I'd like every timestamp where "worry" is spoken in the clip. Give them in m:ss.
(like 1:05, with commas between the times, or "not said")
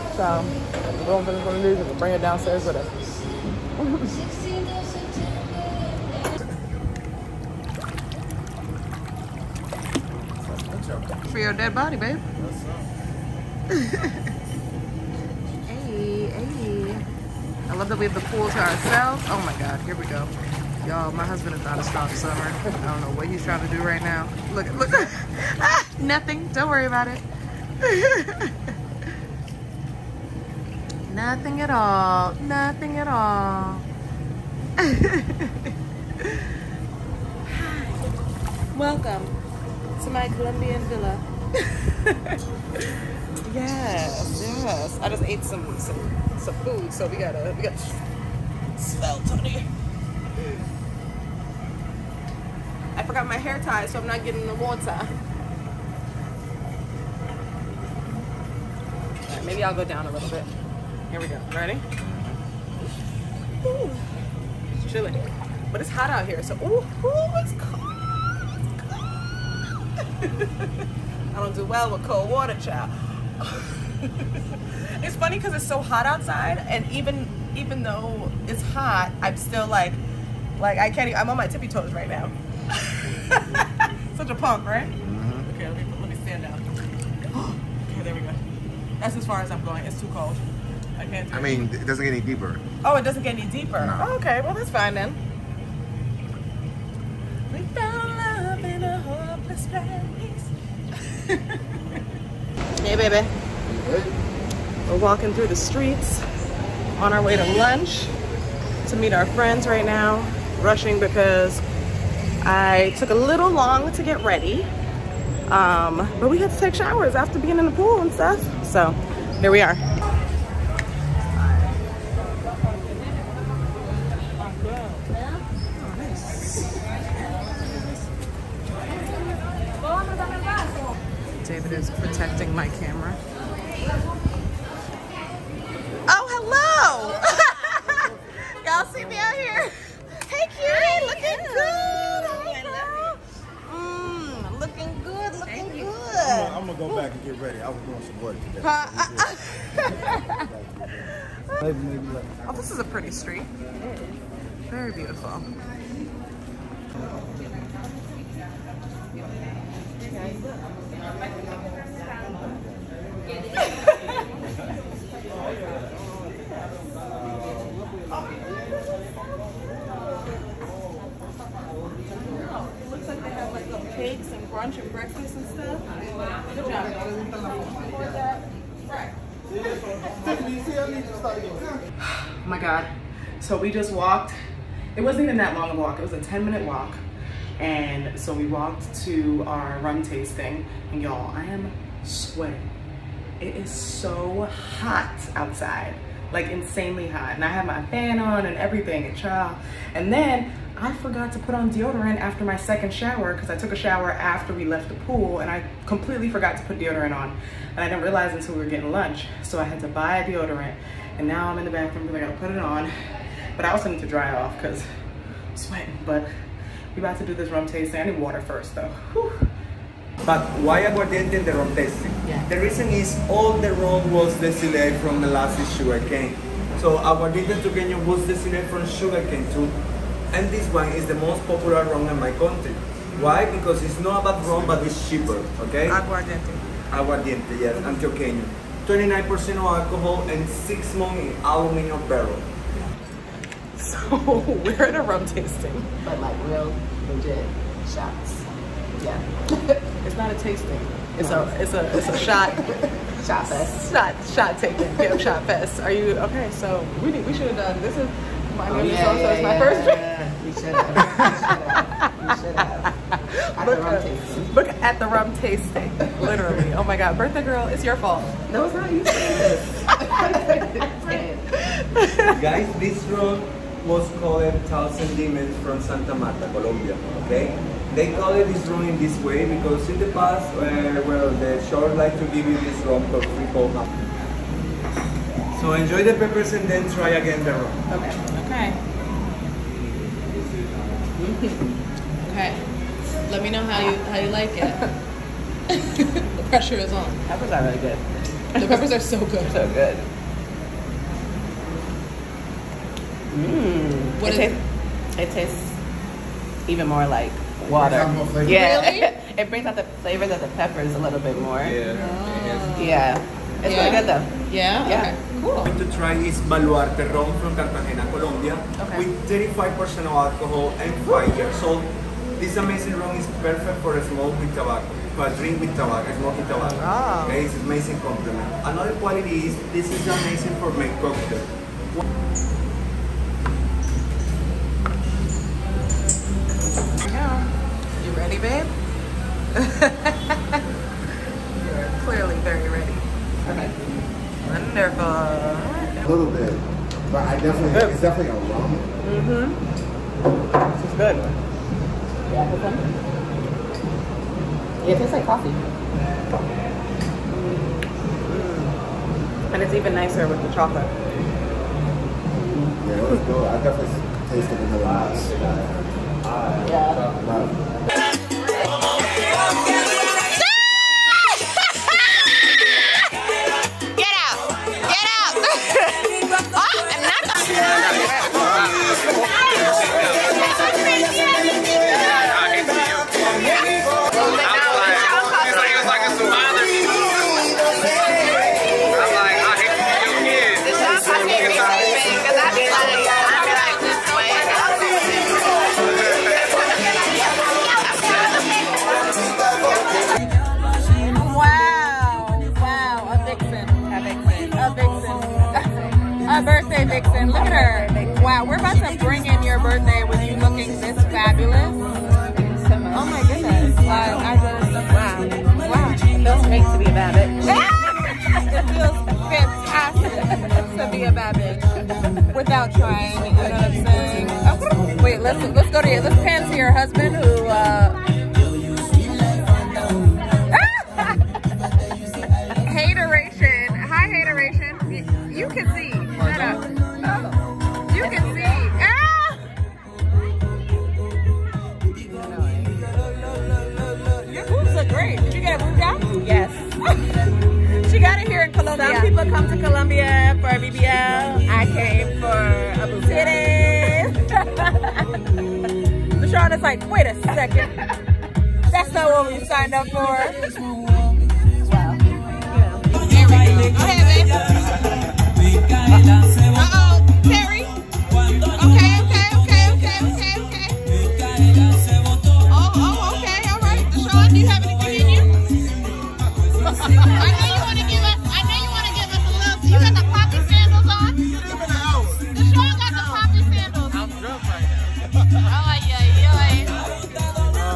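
0:26.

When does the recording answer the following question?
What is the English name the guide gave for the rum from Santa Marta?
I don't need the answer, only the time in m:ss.
4:34.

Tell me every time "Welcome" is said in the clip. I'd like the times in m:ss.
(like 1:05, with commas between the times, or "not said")
0:38.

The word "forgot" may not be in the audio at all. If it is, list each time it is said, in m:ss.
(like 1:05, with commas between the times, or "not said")
0:53, 3:20, 3:26.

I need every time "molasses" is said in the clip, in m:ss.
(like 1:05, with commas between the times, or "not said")
3:45.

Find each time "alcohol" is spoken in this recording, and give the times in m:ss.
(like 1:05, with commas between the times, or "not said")
3:59, 5:20.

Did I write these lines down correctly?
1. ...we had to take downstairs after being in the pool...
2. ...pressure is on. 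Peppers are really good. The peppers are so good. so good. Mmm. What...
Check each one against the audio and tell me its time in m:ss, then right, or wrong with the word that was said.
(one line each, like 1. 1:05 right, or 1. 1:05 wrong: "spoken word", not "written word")
1. 1:56 wrong: "showers", not "downstairs"
2. 4:56 right.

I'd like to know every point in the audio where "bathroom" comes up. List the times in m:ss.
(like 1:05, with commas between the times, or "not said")
3:31.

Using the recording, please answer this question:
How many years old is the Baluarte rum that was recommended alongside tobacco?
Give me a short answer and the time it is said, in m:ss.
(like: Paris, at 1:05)
5, at 5:21.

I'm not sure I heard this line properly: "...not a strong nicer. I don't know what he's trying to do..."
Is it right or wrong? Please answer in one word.
wrong.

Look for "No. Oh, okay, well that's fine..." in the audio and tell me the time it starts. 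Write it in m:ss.
1:33.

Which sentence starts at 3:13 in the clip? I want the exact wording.
It is so hot outside, like insanely hot.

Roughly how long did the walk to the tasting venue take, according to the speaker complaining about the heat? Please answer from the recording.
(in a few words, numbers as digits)
10 minutes.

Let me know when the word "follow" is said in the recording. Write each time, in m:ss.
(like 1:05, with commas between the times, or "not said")
not said.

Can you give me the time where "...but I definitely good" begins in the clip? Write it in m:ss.
5:47.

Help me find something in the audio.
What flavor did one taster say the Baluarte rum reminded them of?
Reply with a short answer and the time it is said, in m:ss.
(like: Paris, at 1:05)
Coffee, at 5:55.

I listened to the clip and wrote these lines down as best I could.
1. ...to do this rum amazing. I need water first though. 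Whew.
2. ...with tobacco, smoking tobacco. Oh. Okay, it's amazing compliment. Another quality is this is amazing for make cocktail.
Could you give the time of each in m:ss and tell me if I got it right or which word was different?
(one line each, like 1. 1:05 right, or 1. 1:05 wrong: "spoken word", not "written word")
1. 3:37 wrong: "tasting", not "amazing"
2. 5:25 right.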